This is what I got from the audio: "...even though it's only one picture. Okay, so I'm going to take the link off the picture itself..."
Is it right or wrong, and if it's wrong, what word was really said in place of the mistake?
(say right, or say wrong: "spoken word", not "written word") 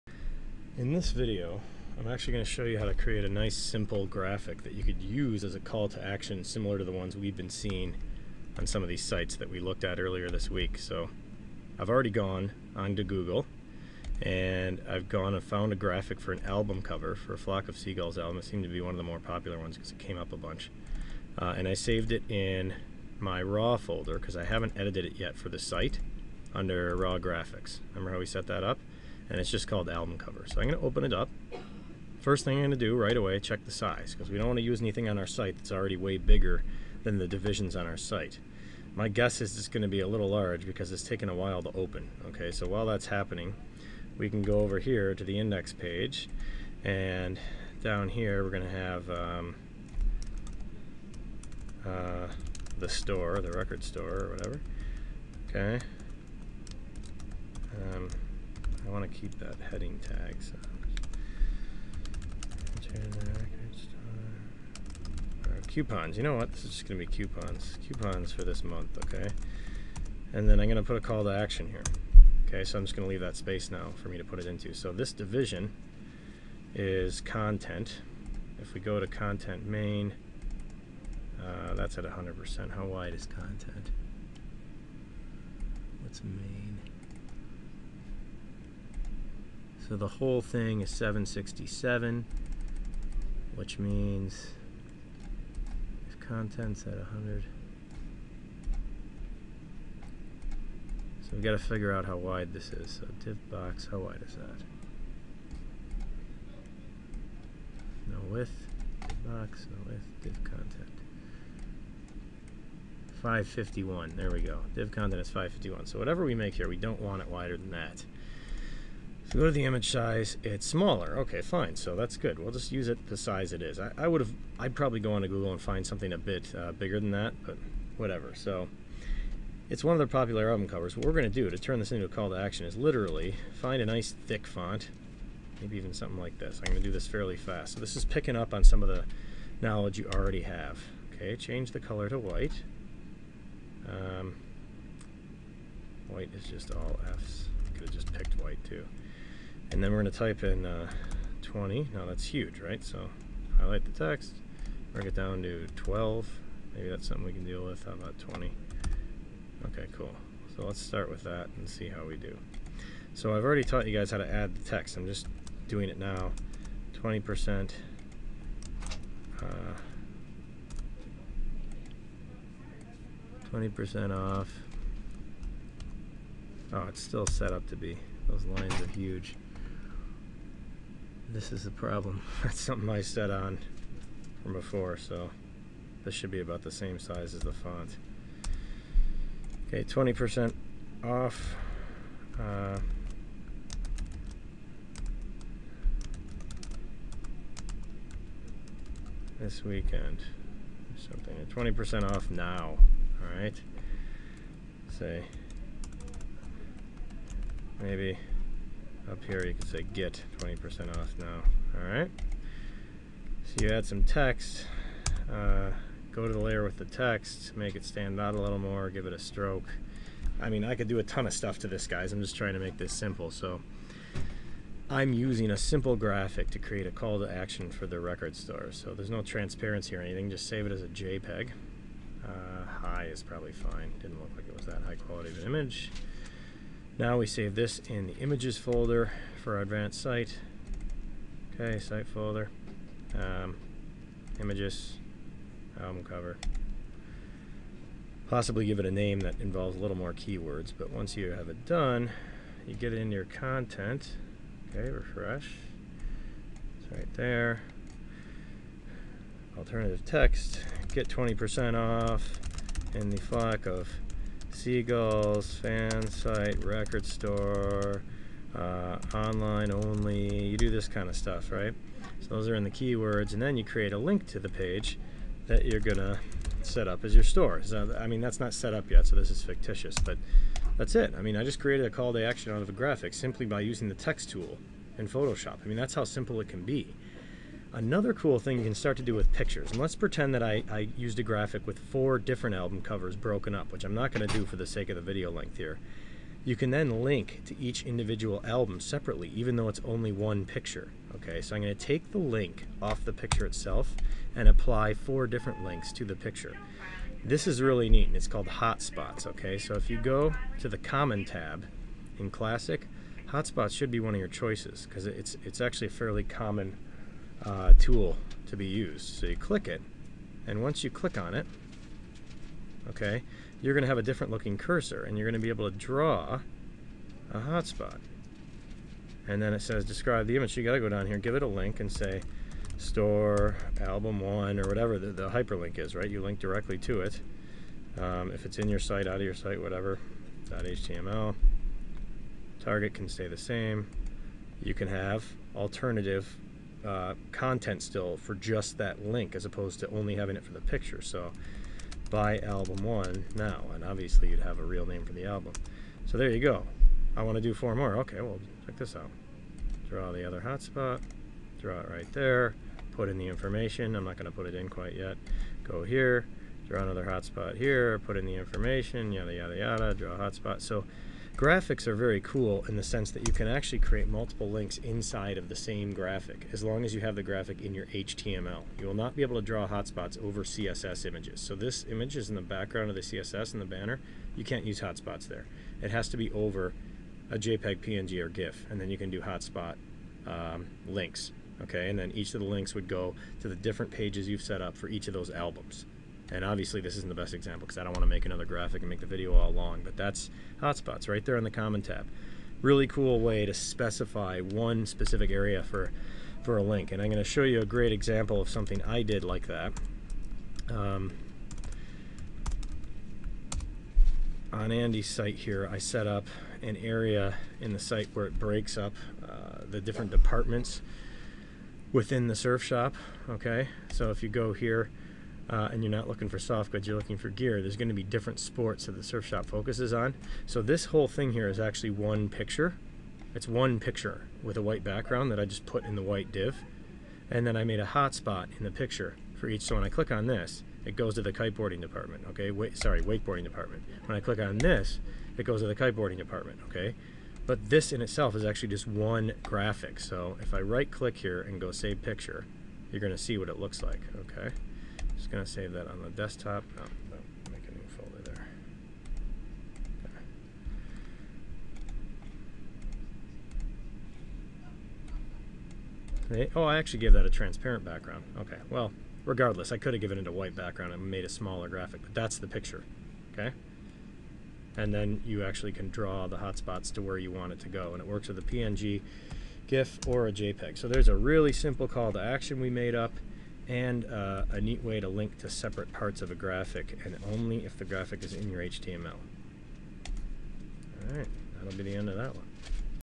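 right.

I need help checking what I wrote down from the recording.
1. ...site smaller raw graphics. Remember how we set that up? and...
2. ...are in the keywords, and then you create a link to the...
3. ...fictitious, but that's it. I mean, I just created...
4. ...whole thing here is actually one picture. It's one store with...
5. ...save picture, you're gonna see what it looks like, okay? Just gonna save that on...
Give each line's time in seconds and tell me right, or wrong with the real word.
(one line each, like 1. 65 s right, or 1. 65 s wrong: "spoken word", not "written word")
1. 25 s wrong: "under", not "smaller"
2. 272 s right
3. 279 s right
4. 430 s wrong: "picture", not "store"
5. 451 s right.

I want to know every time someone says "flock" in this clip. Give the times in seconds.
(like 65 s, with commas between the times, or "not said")
17 s, 263 s.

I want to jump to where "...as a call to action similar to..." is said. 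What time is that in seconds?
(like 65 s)
5 s.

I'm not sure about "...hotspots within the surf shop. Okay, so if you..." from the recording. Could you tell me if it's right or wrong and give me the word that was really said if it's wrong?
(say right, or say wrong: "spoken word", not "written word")
wrong: "departments", not "hotspots".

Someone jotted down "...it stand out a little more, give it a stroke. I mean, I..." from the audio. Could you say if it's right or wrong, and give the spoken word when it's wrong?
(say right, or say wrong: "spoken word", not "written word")
right.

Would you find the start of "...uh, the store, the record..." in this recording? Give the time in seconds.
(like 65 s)
51 s.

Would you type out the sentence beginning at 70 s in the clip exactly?
And then I'm going to put a call to action here.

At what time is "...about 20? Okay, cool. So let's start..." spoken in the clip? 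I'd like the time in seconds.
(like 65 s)
157 s.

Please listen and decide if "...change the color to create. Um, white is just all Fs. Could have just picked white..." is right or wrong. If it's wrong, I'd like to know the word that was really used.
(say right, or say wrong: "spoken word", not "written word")
wrong: "white", not "create".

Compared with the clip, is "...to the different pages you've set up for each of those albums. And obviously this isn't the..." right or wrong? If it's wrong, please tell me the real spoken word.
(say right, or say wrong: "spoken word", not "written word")
right.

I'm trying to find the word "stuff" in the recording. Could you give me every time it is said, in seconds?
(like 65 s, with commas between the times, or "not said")
221 s, 271 s.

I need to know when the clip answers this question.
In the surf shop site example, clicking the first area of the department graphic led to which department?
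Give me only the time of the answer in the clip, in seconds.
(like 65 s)
443 s.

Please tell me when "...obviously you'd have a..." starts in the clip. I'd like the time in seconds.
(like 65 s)
353 s.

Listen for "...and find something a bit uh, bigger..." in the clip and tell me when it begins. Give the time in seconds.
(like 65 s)
125 s.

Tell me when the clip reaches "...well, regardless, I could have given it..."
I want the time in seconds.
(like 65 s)
468 s.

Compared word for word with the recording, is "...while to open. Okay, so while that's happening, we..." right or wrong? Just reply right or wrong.
right.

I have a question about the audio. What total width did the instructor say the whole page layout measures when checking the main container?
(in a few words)
767.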